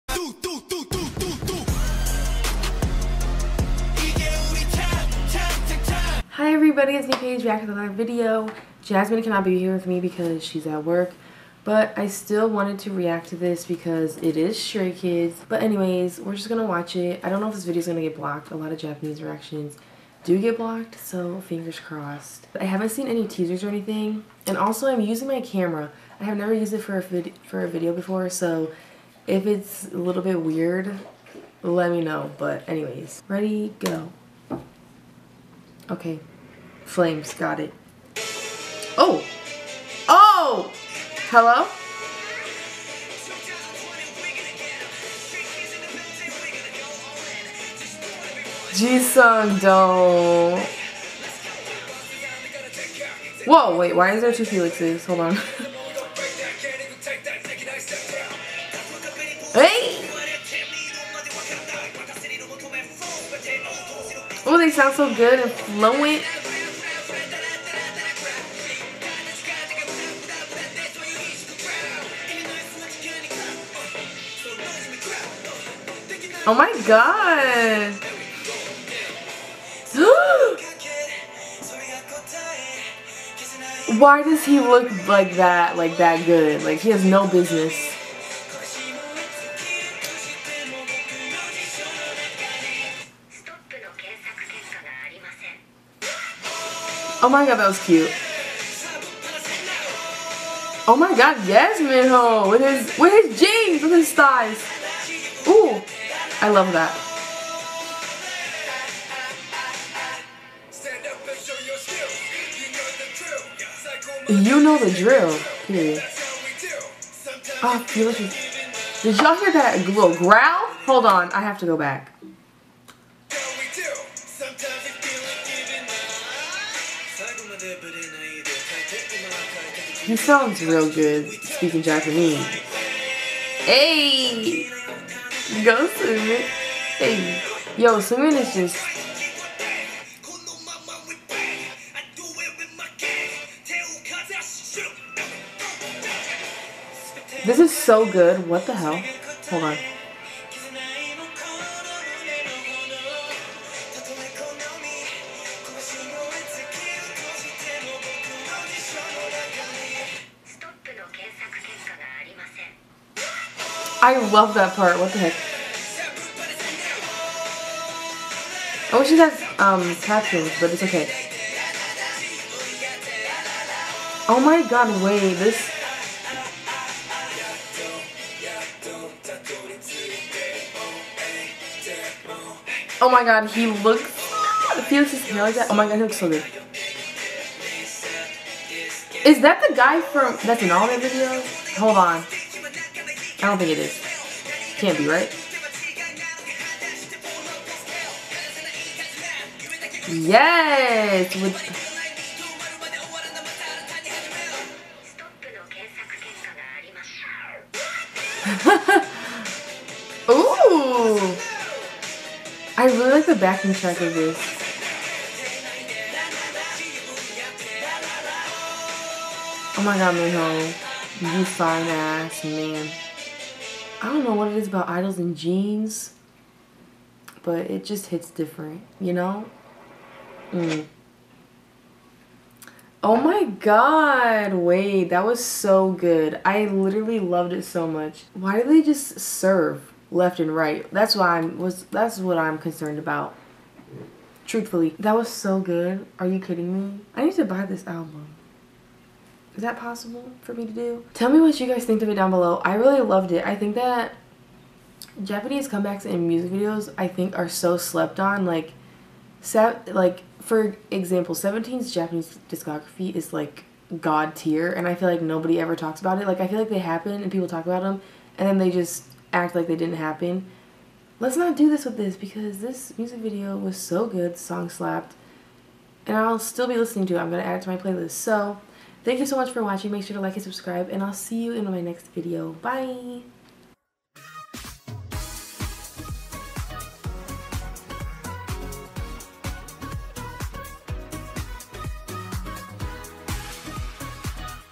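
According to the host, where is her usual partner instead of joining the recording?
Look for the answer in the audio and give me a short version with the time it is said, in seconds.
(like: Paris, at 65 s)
At work, at 10 s.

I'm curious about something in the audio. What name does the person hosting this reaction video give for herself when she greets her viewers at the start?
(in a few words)
Paige.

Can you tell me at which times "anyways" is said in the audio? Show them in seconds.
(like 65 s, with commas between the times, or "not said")
15 s, 32 s.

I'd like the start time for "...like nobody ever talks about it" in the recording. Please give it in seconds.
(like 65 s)
265 s.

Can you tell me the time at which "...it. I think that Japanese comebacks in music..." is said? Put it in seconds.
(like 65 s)
253 s.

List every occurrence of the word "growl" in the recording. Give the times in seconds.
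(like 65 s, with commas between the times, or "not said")
120 s.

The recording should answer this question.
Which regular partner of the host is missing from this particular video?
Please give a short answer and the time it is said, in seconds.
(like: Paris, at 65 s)
Jasmine, at 8 s.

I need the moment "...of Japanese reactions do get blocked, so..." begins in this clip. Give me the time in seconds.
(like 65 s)
18 s.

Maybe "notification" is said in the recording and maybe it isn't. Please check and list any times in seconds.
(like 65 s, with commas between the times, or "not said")
not said.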